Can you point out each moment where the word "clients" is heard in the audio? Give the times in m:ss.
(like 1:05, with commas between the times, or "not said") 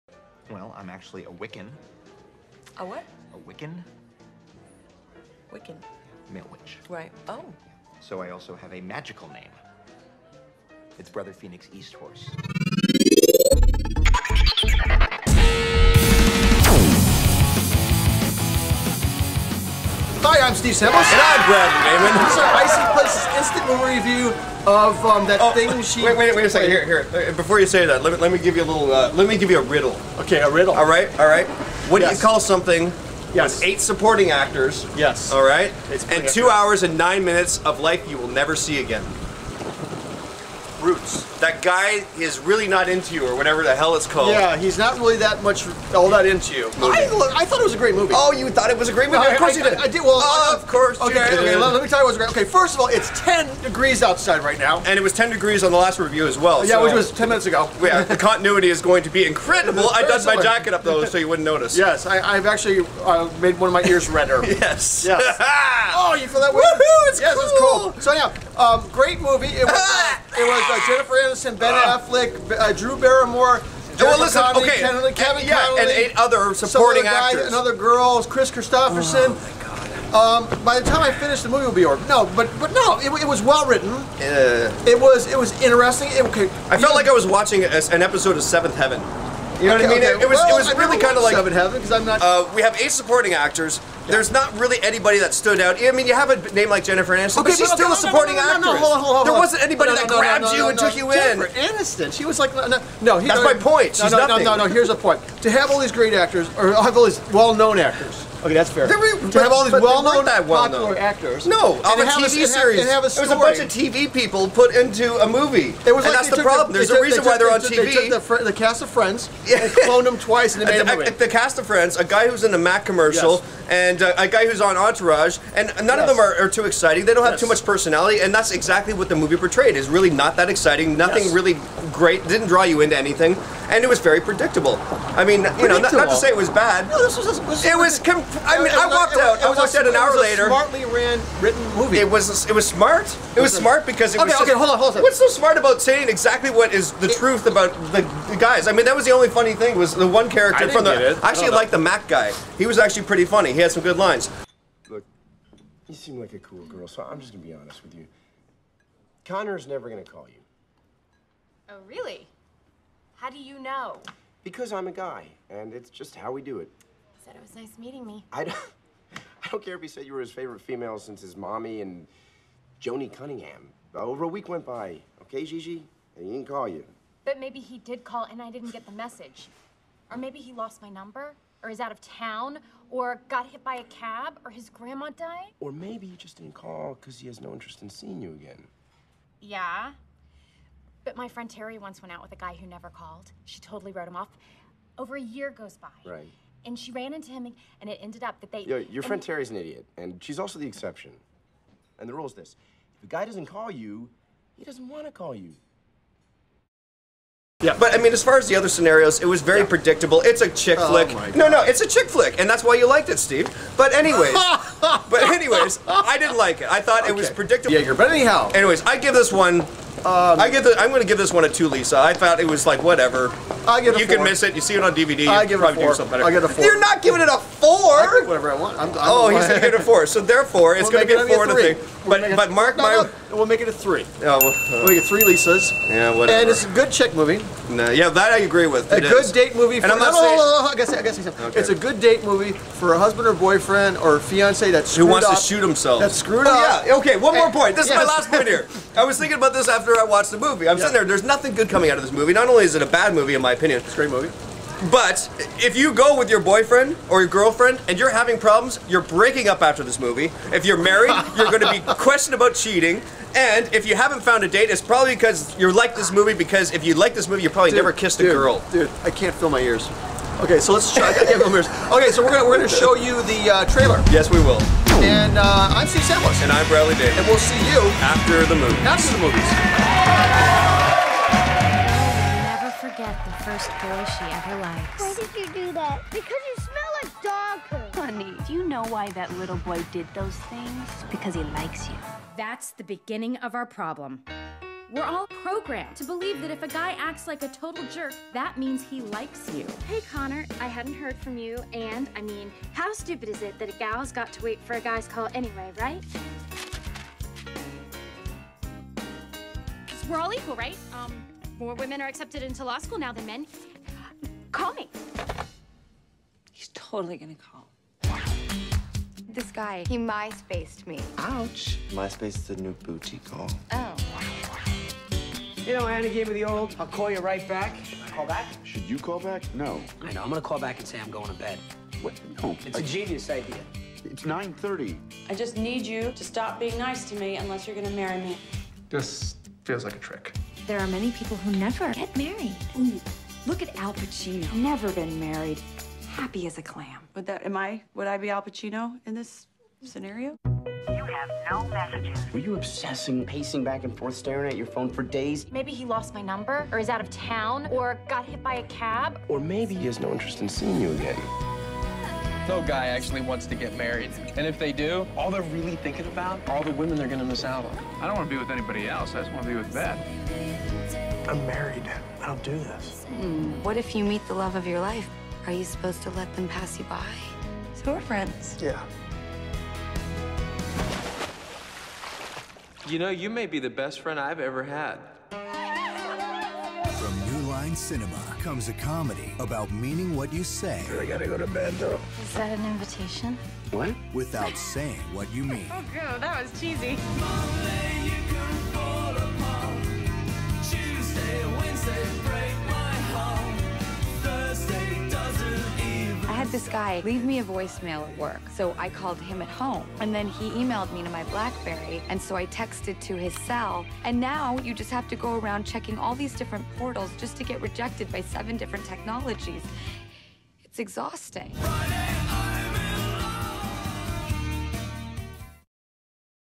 not said.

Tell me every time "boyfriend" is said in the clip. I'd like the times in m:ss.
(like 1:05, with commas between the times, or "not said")
4:03, 4:16.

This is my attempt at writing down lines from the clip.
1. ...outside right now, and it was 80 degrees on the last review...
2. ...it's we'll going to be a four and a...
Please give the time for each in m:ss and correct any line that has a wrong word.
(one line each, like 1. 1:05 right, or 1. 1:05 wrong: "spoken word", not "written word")
1. 0:54 wrong: "10", not "80"
2. 3:50 right.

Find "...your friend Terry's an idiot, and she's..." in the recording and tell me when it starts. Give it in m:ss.
3:18.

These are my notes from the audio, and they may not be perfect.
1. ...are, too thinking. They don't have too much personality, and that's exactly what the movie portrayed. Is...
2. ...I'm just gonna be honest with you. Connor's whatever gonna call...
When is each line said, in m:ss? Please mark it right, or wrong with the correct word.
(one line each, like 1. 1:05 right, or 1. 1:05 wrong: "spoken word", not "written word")
1. 2:06 wrong: "exciting", not "thinking"
2. 2:37 wrong: "never", not "whatever".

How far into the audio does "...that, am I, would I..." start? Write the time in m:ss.
5:47.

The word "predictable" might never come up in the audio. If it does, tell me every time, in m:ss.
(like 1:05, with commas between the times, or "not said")
2:14, 3:29, 3:37.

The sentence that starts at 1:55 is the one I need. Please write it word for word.
There was and like that's the problem.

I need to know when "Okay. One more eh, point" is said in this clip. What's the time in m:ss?
4:06.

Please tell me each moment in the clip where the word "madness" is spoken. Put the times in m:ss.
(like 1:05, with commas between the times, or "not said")
not said.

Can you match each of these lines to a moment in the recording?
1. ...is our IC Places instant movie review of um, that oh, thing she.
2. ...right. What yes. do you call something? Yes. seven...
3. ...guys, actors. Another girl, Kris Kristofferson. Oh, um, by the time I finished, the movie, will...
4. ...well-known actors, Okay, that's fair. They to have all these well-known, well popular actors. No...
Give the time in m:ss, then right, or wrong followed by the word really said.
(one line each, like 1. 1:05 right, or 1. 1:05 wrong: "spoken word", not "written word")
1. 0:22 right
2. 0:31 wrong: "eight", not "seven"
3. 1:17 right
4. 1:47 right.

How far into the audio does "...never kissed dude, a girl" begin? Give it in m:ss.
4:27.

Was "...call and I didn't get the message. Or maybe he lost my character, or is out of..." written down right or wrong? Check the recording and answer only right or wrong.
wrong.